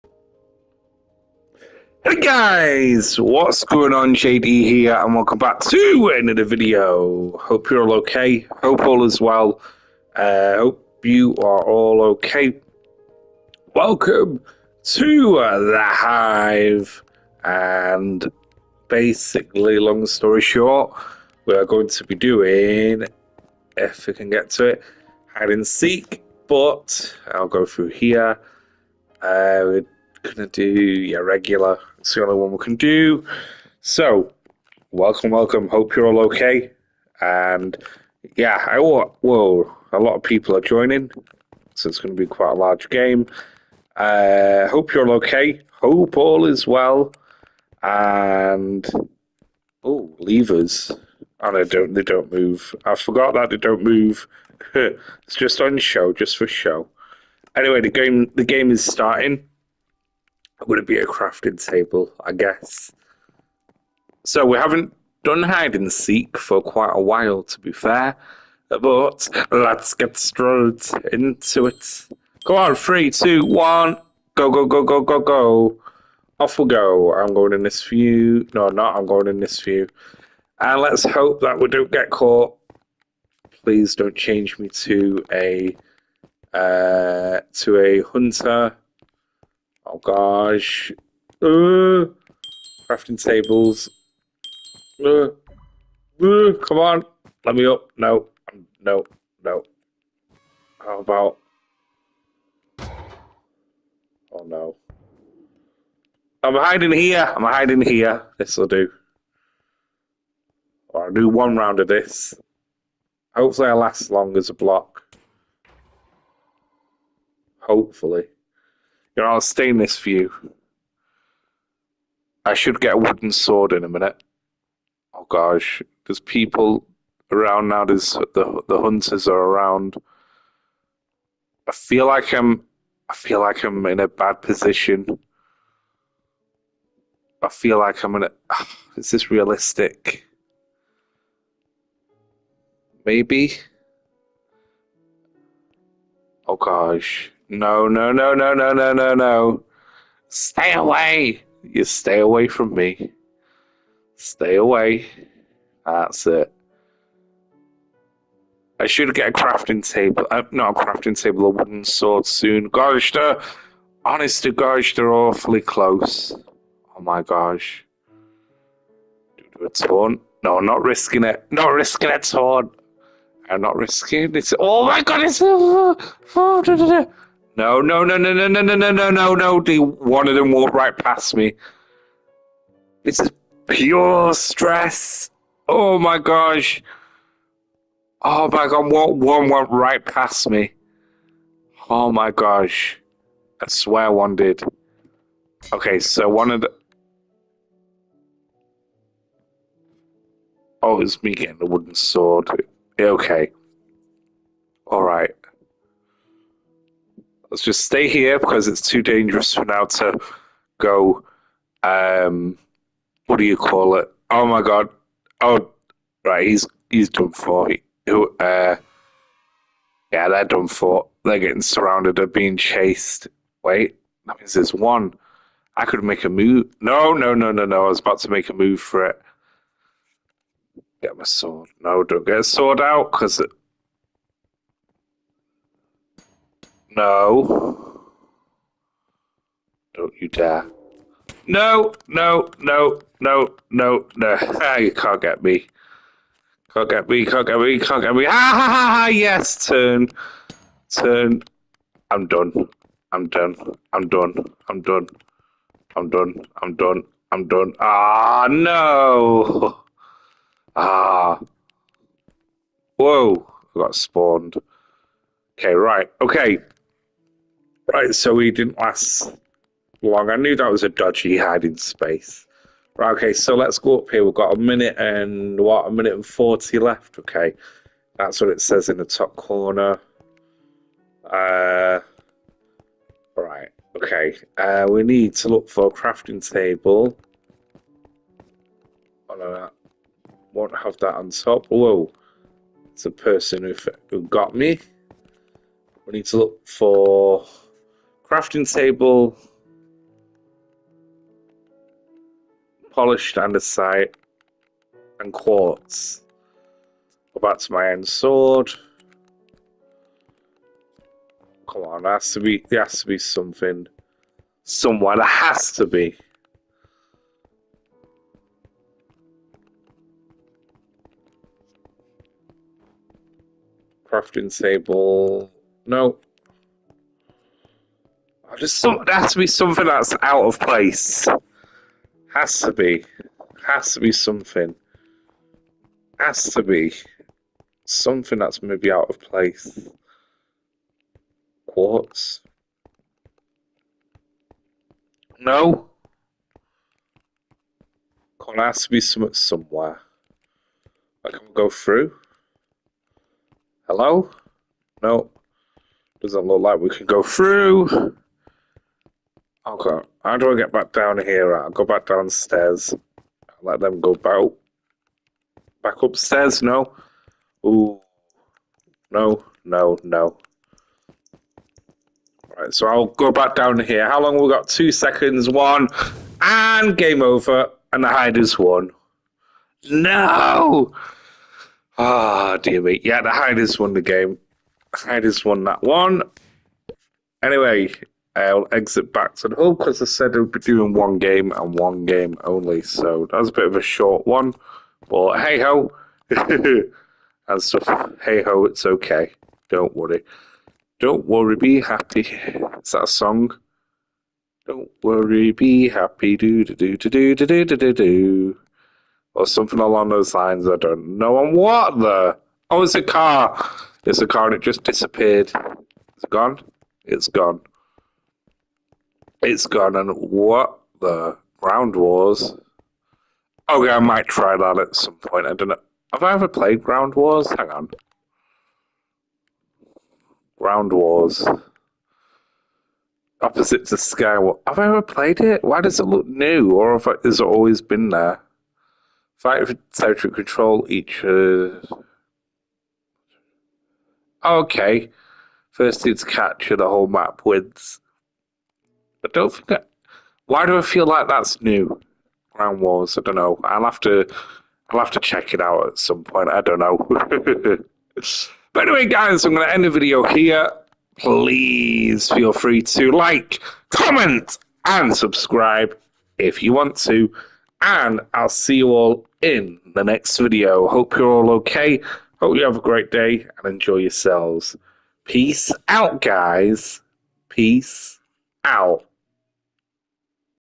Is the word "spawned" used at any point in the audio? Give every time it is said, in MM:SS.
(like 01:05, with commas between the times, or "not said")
04:23.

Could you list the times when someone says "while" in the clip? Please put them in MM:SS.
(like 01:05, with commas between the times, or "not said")
01:07.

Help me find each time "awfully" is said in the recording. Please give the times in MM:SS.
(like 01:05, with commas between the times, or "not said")
02:45.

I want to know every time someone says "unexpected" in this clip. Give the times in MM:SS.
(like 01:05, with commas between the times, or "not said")
not said.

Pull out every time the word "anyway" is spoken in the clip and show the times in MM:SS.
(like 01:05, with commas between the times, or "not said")
00:57, 06:27, 07:38.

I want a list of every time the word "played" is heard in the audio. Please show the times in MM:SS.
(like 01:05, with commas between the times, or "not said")
07:06, 07:15.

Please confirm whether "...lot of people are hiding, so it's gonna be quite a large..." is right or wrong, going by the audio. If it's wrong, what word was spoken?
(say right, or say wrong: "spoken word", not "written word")
wrong: "joining", not "hiding".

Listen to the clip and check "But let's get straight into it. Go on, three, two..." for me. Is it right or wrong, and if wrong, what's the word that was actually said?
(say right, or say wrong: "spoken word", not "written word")
right.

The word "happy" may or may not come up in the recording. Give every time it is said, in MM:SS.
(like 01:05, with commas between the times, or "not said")
06:41, 06:45.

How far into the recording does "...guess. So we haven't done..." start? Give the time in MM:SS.
01:02.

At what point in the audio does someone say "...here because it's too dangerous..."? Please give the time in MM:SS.
03:28.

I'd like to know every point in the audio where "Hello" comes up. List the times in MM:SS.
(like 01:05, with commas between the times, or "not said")
05:53.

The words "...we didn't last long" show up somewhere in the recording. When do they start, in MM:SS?
04:28.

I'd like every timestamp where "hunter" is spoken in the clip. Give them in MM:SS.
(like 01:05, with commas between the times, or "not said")
01:28, 02:08.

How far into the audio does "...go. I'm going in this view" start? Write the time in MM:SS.
01:16.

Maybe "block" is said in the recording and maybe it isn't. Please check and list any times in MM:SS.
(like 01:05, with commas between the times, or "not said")
01:54.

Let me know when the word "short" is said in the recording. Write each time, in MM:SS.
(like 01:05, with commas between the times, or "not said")
00:20, 06:33.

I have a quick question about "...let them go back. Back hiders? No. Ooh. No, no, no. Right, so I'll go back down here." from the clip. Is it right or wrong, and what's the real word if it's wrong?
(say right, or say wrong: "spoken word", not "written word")
wrong: "upstairs", not "hiders".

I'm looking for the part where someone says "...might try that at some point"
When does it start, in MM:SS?
07:03.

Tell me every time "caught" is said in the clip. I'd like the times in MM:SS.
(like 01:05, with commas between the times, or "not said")
01:22.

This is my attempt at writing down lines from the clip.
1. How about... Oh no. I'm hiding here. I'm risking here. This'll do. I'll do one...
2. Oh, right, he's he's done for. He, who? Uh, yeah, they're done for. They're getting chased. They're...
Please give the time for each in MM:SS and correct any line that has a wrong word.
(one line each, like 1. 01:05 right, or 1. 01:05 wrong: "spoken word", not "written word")
1. 01:40 wrong: "hiding", not "risking"
2. 03:35 wrong: "surrounded", not "chased".